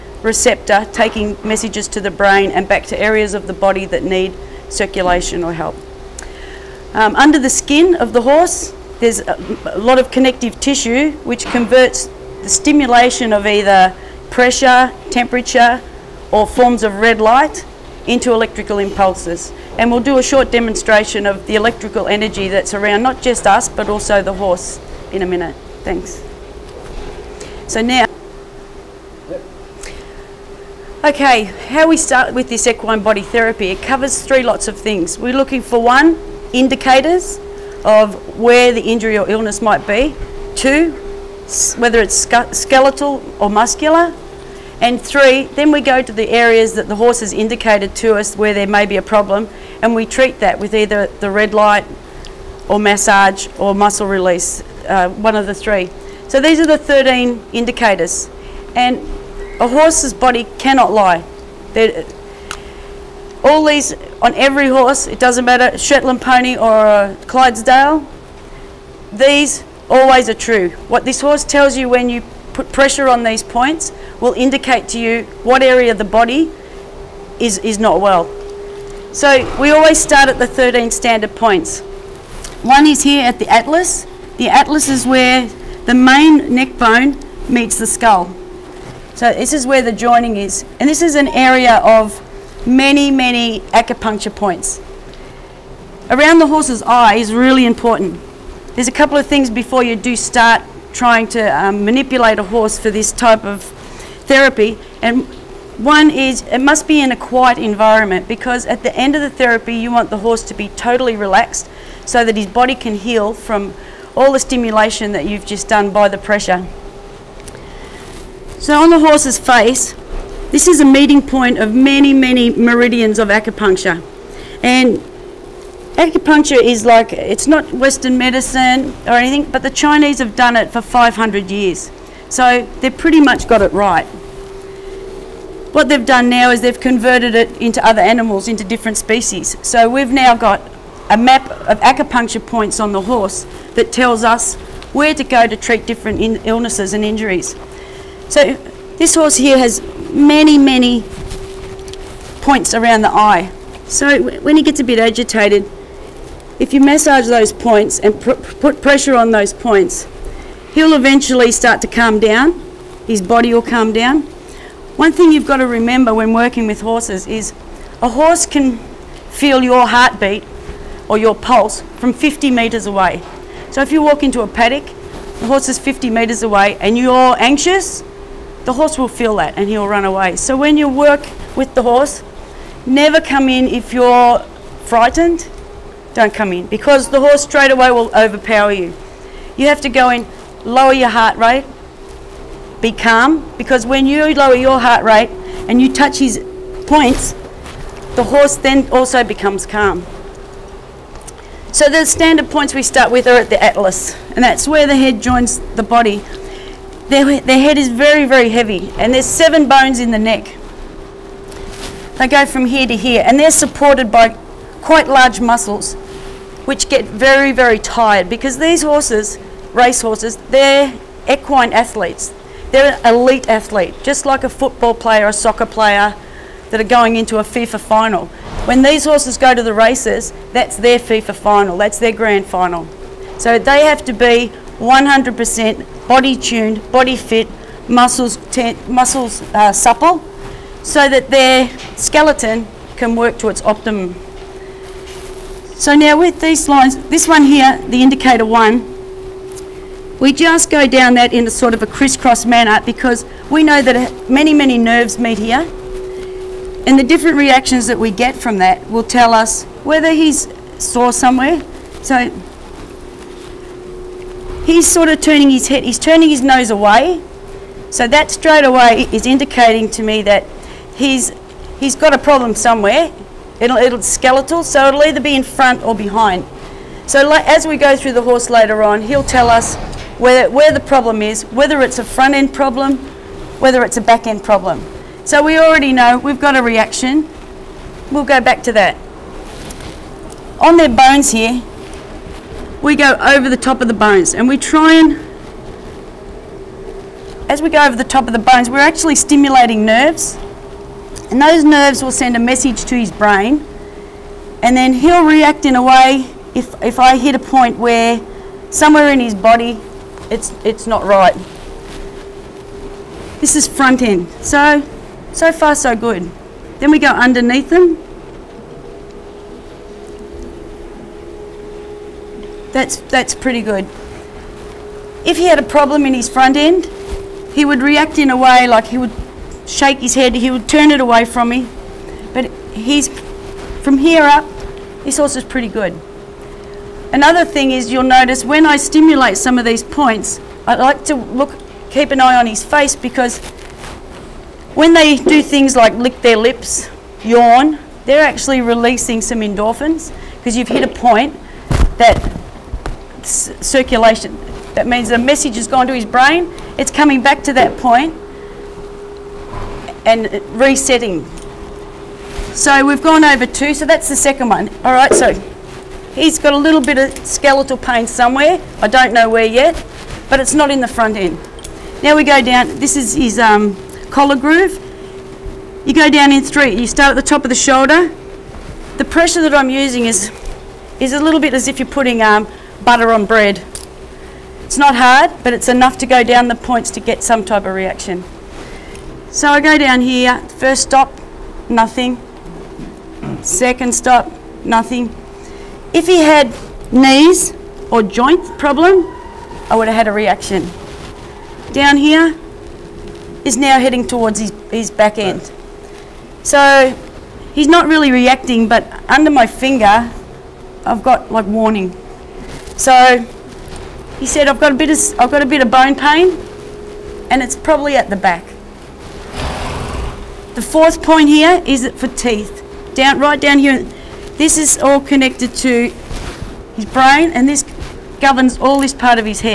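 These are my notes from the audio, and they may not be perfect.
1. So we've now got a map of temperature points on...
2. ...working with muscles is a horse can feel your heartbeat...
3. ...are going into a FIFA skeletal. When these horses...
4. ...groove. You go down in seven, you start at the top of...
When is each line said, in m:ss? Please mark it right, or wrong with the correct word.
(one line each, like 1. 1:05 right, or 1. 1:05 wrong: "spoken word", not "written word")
1. 2:19 wrong: "acupuncture", not "temperature"
2. 2:46 wrong: "horses", not "muscles"
3. 3:46 wrong: "final", not "skeletal"
4. 6:14 wrong: "three", not "seven".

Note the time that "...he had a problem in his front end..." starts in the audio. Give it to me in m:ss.
5:25.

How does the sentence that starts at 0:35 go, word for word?
We're looking for one, indicators of where the injury or illness might be.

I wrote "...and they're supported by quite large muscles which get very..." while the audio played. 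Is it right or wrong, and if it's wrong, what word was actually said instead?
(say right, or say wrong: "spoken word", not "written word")
right.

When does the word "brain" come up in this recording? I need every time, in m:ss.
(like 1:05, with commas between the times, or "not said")
0:02, 5:03, 5:56, 7:06.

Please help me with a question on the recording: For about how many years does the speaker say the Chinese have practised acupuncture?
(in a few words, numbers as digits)
500 years.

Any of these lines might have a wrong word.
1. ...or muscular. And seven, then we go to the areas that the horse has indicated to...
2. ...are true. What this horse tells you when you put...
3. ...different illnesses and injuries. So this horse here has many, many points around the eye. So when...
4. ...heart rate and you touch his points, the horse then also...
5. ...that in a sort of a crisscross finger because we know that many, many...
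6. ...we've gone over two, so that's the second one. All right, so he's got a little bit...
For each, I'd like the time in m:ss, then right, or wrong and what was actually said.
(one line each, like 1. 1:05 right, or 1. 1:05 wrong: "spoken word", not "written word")
1. 0:43 wrong: "three", not "seven"
2. 1:10 right
3. 2:25 right
4. 3:14 right
5. 4:11 wrong: "manner", not "finger"
6. 6:02 right.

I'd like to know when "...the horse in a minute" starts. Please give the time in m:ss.
0:24.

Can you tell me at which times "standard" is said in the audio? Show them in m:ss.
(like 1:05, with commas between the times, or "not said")
1:20, 3:22.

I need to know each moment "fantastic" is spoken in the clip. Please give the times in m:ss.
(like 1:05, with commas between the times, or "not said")
not said.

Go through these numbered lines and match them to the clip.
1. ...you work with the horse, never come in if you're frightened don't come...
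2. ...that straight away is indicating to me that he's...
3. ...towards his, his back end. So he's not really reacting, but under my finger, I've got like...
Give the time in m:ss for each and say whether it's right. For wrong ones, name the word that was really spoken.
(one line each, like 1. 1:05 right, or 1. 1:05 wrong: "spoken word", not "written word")
1. 3:00 right
2. 4:28 right
3. 6:44 right.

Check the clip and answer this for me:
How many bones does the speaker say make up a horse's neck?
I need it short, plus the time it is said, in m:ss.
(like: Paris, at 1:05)
Seven, at 3:29.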